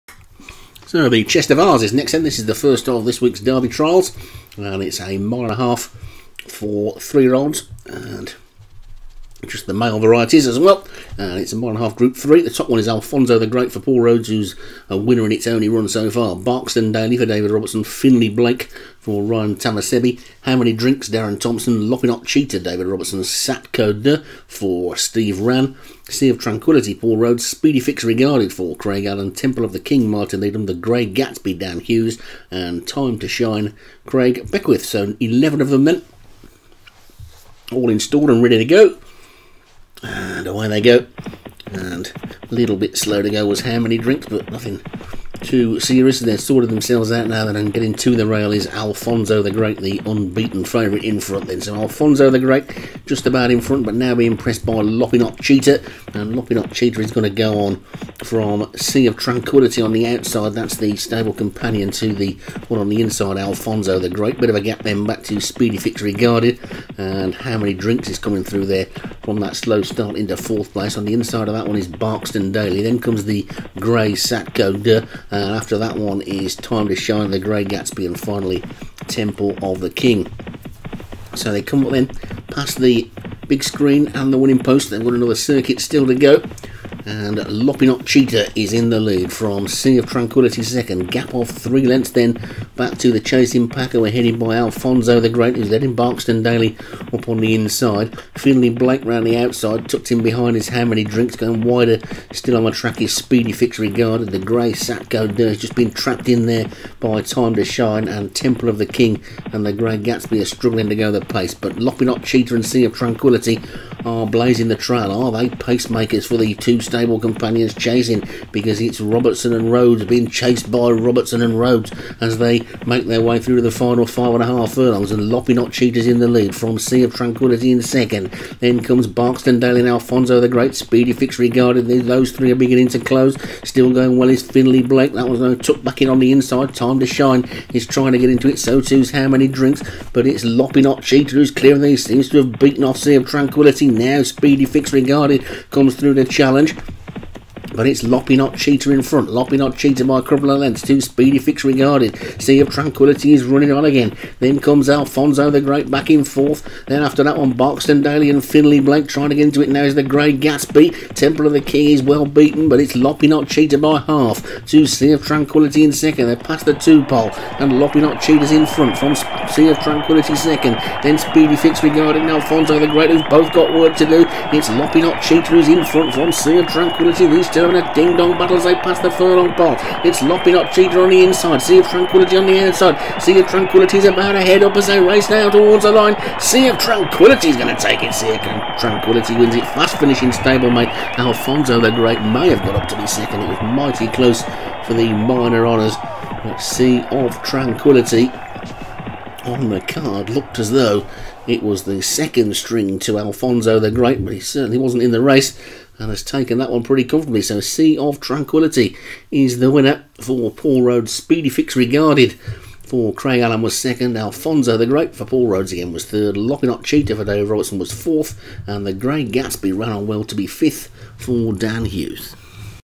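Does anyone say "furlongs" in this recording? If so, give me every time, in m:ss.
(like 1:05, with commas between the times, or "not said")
2:04, 2:59.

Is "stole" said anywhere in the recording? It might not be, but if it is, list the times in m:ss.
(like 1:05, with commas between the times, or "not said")
not said.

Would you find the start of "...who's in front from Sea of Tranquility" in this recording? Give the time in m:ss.
2:55.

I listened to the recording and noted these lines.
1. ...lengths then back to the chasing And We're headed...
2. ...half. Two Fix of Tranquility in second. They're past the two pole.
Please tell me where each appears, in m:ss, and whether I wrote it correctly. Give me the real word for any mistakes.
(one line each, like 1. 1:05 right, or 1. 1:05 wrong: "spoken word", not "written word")
1. 1:31 right
2. 2:44 wrong: "Sea", not "Fix".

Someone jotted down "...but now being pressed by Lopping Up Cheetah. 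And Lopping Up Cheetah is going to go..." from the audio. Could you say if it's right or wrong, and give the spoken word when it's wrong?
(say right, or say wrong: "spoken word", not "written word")
right.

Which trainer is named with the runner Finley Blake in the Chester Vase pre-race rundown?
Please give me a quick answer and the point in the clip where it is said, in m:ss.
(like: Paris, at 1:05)
Ryan Tamasebi, at 0:19.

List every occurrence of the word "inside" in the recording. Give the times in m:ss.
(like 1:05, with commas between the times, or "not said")
1:03, 1:11, 1:37, 2:16, 3:01.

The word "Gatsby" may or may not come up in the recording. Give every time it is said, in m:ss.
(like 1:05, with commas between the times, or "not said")
0:31, 1:17, 1:49, 2:40, 3:39.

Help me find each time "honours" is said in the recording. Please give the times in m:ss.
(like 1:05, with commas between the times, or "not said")
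3:15.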